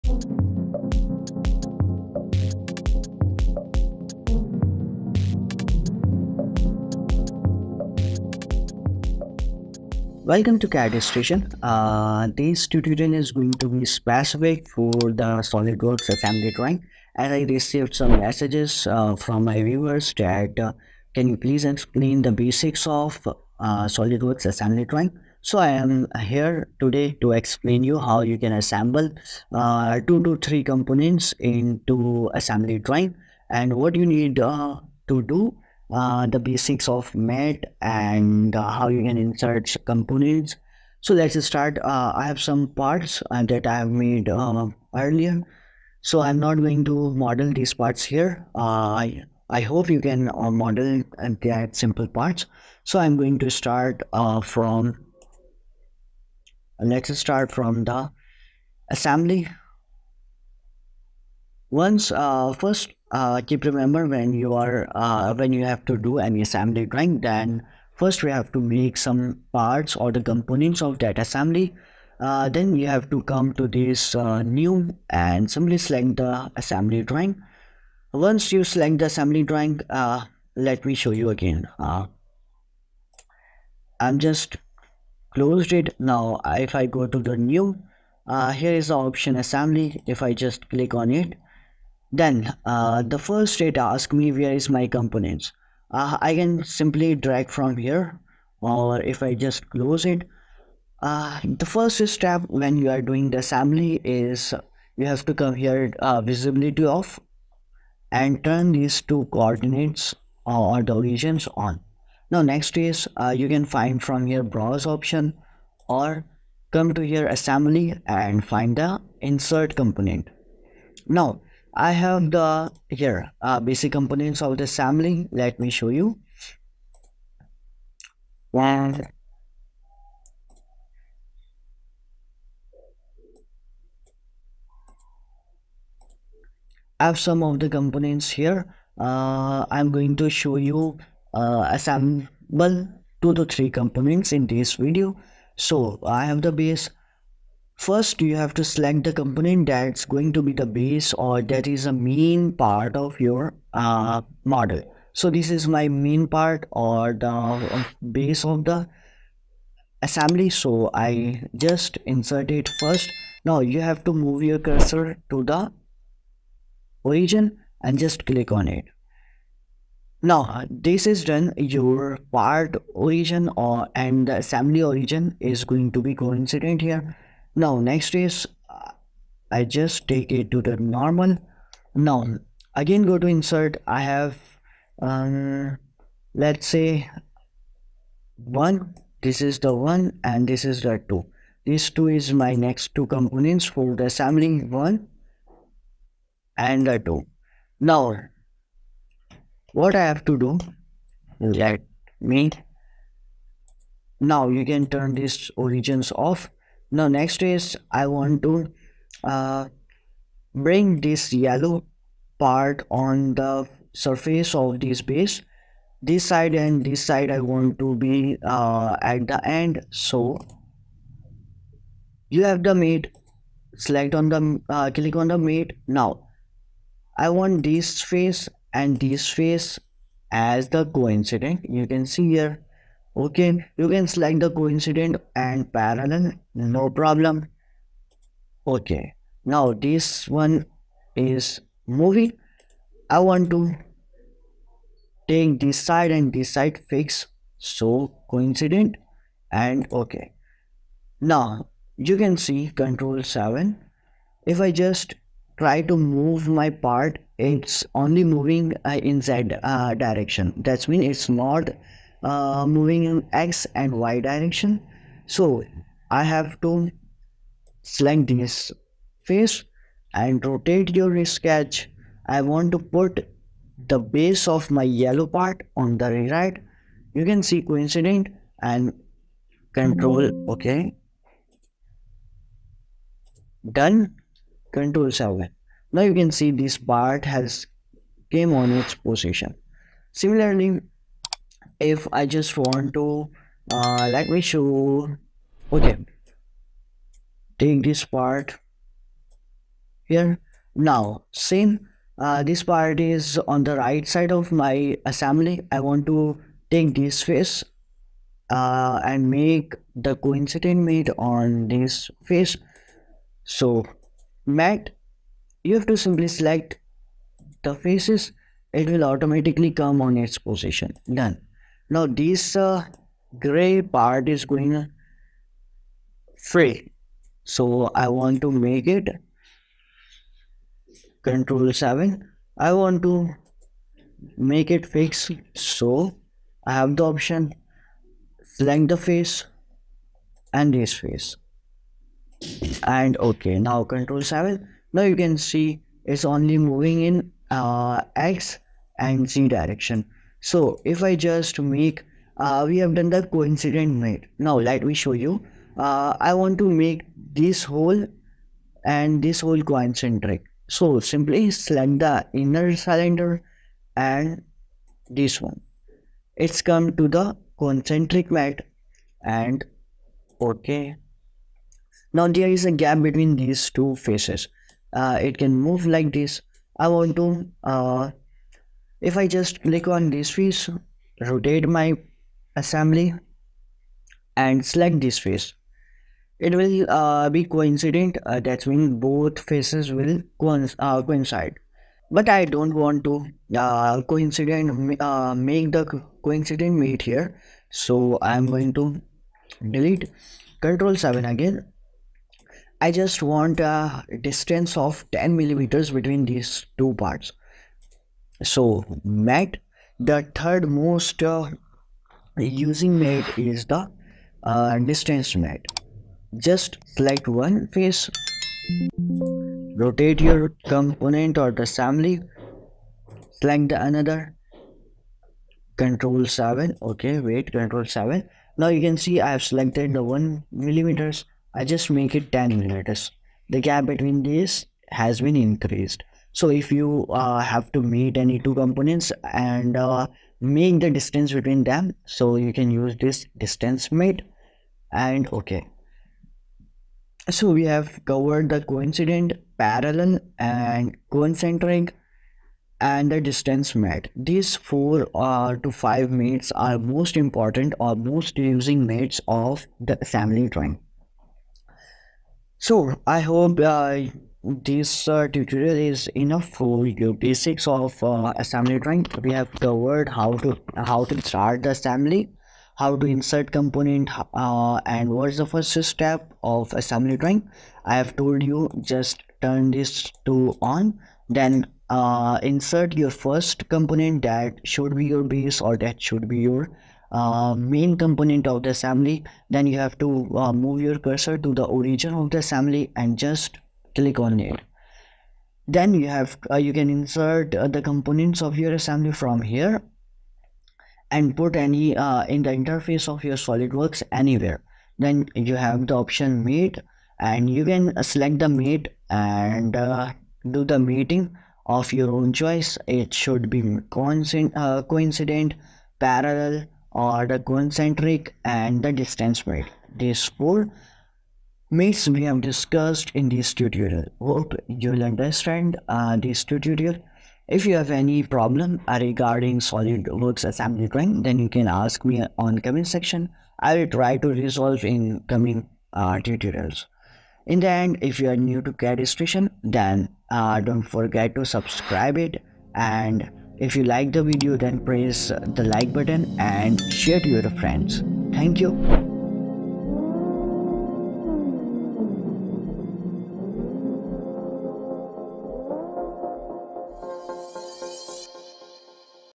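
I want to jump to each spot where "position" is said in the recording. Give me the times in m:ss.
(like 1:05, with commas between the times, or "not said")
4:48, 5:20.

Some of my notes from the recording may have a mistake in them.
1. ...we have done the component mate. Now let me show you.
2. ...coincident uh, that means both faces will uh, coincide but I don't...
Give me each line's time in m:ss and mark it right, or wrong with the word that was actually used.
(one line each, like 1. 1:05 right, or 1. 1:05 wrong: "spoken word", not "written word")
1. 5:52 wrong: "coincident", not "component"
2. 6:27 right.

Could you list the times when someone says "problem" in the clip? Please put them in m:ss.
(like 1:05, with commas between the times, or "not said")
3:56, 8:48.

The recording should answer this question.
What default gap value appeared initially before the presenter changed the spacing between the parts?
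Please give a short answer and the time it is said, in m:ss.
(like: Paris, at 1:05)
1 millimeter, at 7:10.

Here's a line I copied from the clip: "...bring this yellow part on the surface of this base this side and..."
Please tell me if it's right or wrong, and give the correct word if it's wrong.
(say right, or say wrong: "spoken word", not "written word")
right.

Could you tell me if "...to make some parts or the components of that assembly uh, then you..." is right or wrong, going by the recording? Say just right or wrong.
right.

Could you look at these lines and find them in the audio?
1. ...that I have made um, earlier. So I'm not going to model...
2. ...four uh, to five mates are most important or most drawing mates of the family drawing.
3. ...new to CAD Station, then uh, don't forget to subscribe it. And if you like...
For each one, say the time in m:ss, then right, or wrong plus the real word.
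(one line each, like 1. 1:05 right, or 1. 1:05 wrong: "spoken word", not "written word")
1. 0:43 right
2. 7:34 wrong: "using", not "drawing"
3. 8:58 right.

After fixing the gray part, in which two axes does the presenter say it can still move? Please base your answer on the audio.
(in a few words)
X and Z.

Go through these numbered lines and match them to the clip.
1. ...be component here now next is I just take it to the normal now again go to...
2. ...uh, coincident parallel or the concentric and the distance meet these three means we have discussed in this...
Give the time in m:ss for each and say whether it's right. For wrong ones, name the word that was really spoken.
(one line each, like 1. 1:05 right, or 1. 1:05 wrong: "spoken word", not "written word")
1. 2:56 wrong: "coincident", not "component"
2. 8:34 wrong: "four", not "three".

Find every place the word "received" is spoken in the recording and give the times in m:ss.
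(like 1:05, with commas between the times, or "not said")
0:17.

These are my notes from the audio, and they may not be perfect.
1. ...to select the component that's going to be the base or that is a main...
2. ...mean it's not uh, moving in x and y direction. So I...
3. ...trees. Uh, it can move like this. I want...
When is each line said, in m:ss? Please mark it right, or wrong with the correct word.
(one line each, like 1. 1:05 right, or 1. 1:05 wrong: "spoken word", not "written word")
1. 2:28 right
2. 4:20 right
3. 6:13 wrong: "faces", not "trees".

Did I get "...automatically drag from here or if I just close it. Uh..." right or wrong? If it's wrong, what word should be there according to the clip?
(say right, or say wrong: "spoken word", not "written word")
wrong: "simply", not "automatically".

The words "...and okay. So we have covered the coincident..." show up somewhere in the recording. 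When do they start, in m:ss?
7:24.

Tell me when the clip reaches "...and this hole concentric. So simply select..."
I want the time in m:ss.
5:58.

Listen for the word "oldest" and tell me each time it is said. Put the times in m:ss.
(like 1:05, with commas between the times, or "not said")
not said.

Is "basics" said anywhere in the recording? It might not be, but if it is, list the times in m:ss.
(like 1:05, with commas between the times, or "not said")
0:22, 0:36, 2:03, 7:47.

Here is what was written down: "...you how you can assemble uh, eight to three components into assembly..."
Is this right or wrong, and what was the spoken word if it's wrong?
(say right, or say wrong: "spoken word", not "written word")
wrong: "two", not "eight".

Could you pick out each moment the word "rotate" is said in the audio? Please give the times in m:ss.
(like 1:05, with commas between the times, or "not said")
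4:30, 6:21, 6:59.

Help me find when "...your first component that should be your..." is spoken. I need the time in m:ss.
8:02.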